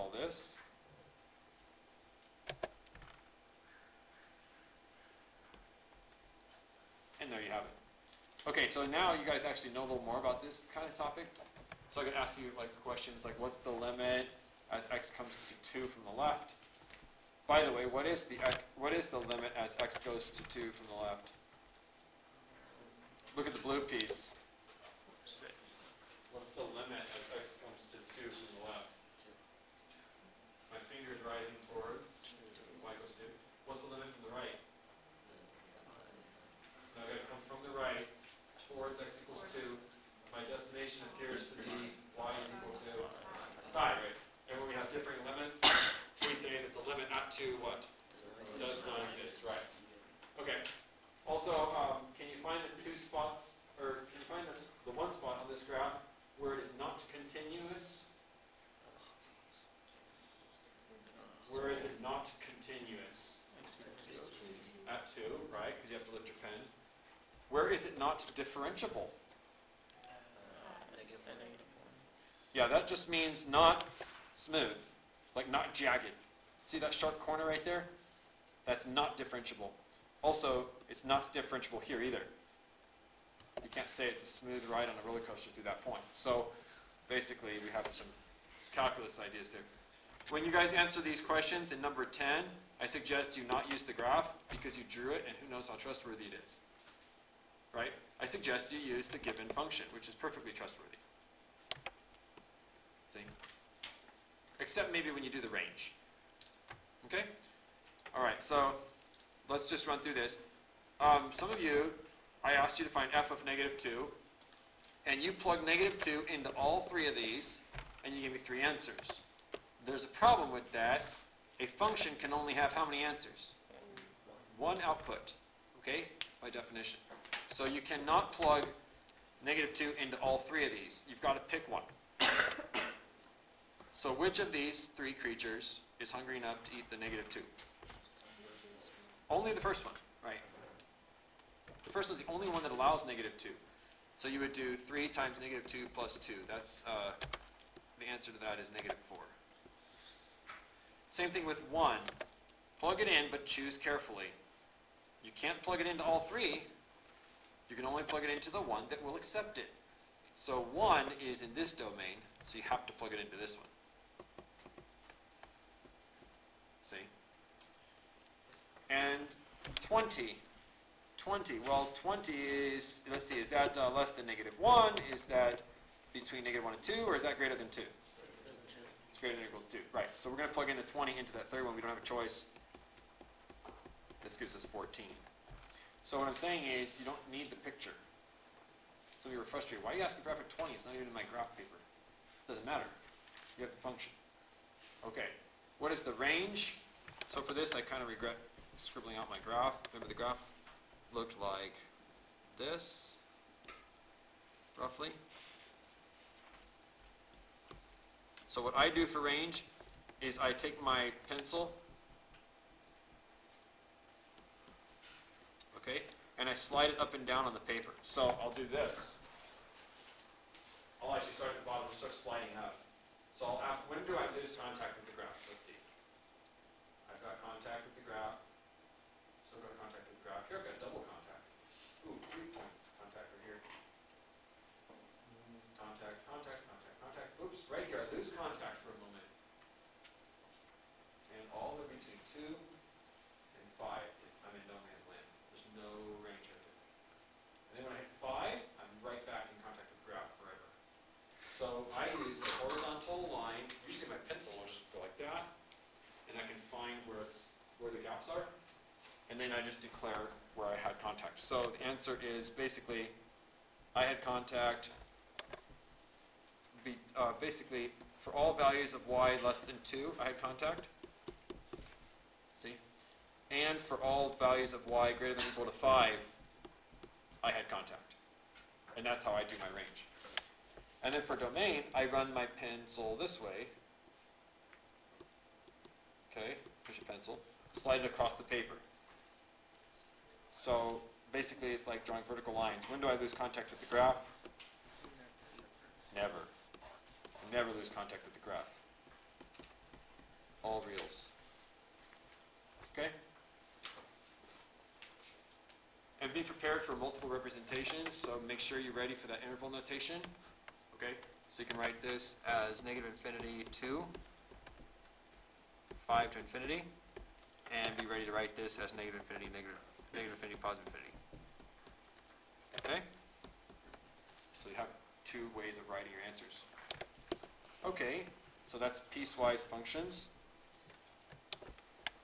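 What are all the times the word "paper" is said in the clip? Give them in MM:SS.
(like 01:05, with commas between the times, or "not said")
03:11, 03:37, 04:48.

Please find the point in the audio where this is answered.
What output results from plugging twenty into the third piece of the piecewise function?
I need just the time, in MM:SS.
03:04.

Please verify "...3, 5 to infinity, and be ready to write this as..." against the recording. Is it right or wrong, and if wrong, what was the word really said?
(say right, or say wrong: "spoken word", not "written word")
wrong: "2", not "3".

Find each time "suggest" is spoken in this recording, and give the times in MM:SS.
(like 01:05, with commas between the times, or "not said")
01:32, 01:38.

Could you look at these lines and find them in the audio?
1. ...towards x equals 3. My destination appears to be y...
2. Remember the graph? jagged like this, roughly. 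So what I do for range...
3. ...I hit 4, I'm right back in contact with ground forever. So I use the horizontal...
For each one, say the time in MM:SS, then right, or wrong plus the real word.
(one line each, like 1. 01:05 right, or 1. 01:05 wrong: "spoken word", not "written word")
1. 00:38 wrong: "2", not "3"
2. 03:19 wrong: "looked", not "jagged"
3. 04:07 wrong: "5", not "4".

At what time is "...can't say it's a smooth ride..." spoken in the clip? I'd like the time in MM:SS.
01:23.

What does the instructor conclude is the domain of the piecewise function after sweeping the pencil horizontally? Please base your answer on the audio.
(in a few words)
All reals.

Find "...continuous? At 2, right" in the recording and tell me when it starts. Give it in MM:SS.
01:02.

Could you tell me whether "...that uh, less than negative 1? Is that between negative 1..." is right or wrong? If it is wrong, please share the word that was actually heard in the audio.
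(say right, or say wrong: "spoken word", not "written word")
right.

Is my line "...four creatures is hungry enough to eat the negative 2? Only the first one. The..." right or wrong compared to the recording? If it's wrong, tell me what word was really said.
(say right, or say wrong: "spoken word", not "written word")
wrong: "three", not "four".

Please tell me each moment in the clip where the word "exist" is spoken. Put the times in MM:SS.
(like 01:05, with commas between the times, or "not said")
00:49.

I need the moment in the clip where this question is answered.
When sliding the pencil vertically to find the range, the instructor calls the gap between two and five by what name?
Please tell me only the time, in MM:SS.
04:04.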